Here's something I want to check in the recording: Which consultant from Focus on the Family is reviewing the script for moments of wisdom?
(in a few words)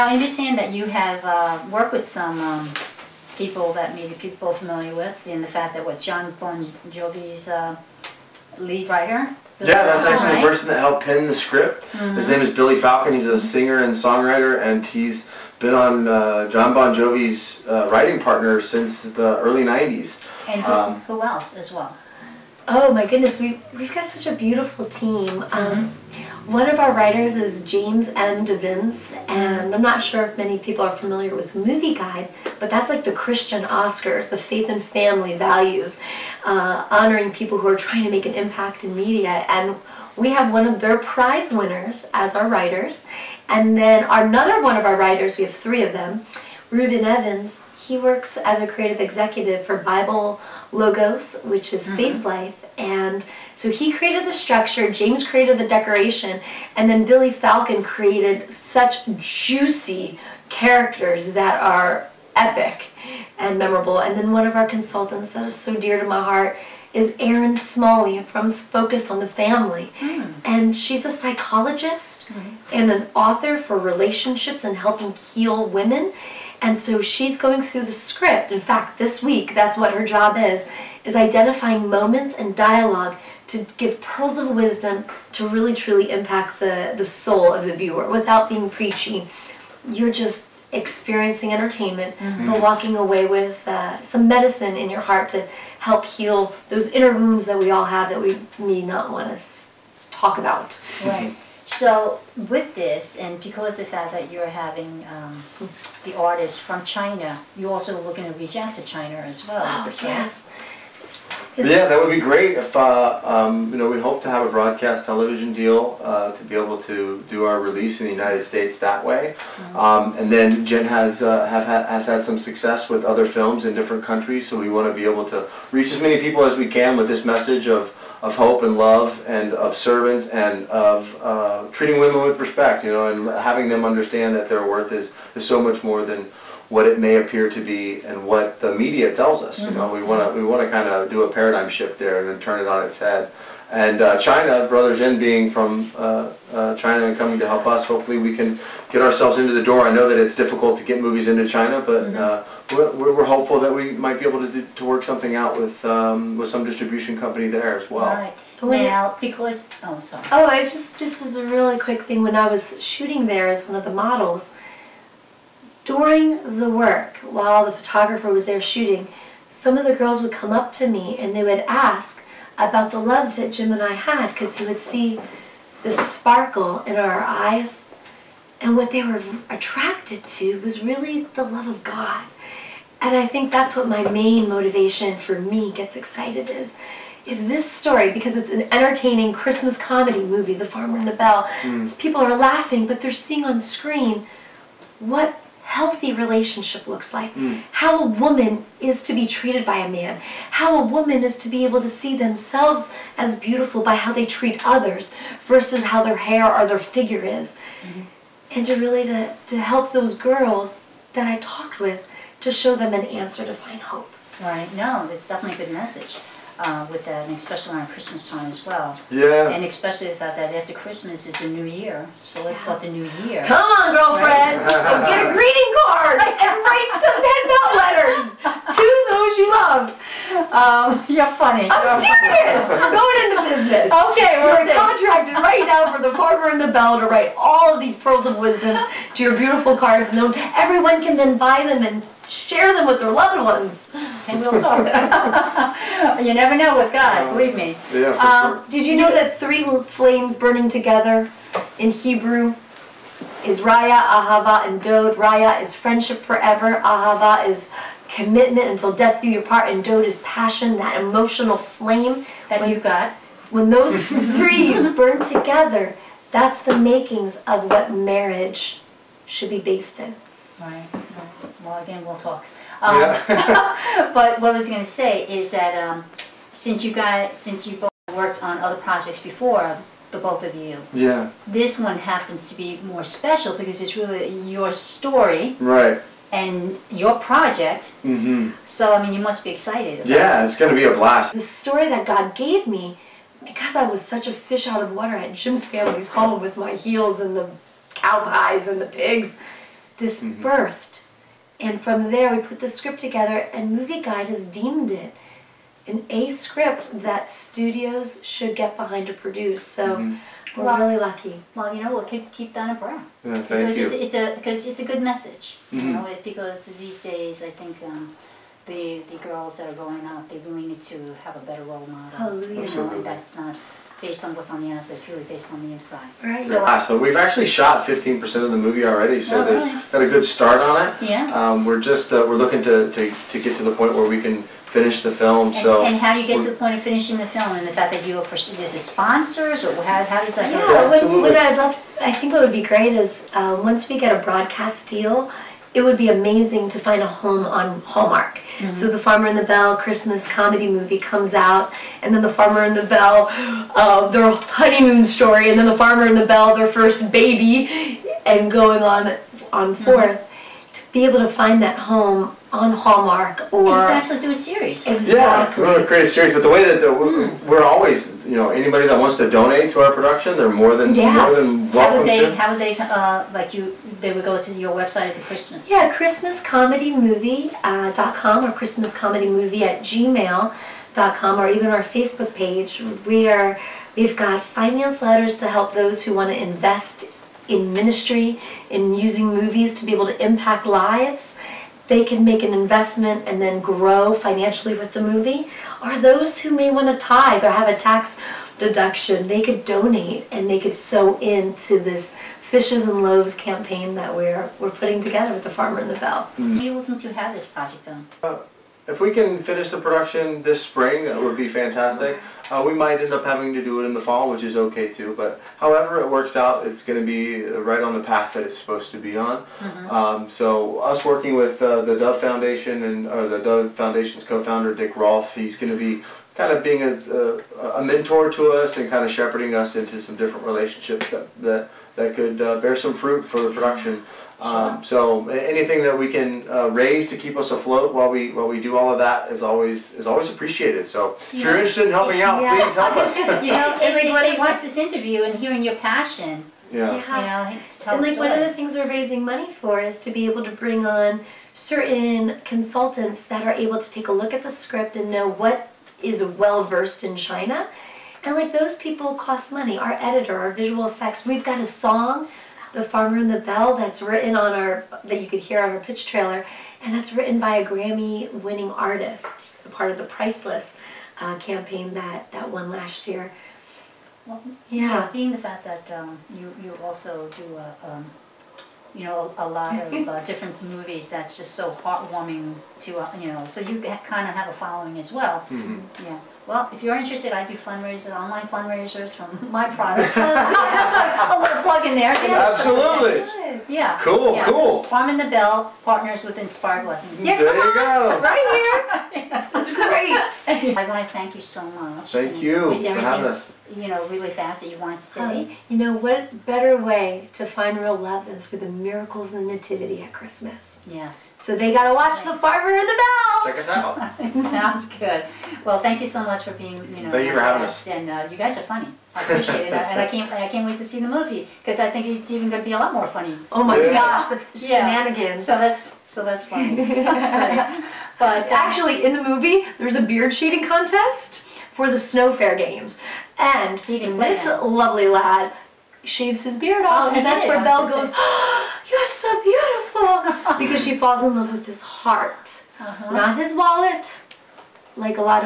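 Erin Smalley.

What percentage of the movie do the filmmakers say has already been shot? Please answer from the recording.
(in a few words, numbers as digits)
15%.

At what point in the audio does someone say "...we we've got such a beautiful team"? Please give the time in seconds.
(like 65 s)
23 s.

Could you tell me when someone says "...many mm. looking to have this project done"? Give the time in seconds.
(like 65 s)
406 s.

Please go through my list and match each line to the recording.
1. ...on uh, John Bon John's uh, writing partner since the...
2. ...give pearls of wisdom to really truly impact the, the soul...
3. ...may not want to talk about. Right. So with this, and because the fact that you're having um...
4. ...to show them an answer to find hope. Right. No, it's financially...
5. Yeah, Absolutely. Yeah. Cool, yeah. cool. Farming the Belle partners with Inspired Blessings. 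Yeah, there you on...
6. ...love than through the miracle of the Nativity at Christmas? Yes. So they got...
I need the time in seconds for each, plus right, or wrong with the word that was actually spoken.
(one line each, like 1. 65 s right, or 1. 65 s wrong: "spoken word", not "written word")
1. 15 s wrong: "Jovi", not "John"
2. 83 s right
3. 98 s right
4. 212 s wrong: "definitely", not "financially"
5. 492 s right
6. 507 s right.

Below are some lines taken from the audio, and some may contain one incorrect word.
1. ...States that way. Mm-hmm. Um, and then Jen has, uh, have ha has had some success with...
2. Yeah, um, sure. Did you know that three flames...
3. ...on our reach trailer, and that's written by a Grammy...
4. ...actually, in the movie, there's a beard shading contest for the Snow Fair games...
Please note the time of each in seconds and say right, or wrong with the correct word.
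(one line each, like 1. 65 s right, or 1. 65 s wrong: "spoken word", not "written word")
1. 118 s right
2. 247 s right
3. 465 s wrong: "pitch", not "reach"
4. 528 s right.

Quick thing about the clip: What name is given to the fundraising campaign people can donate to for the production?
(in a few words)
Fishes and Loaves.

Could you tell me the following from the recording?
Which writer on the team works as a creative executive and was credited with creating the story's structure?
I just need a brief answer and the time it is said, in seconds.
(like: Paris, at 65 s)
Ruben Evans, at 46 s.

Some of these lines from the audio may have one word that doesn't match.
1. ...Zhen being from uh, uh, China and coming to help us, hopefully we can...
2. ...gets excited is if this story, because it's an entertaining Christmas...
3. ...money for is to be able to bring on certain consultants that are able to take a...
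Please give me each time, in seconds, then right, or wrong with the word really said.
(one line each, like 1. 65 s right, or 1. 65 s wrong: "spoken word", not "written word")
1. 144 s right
2. 185 s right
3. 449 s right.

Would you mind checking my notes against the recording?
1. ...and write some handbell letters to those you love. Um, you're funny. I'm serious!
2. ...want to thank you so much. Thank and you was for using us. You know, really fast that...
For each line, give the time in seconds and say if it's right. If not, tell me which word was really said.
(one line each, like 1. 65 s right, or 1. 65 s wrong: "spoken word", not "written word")
1. 226 s right
2. 500 s wrong: "having", not "using".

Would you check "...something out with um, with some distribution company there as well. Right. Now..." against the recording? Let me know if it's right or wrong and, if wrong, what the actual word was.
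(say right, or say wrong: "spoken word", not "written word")
right.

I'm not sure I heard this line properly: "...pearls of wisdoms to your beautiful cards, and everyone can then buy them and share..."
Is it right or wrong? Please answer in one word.
right.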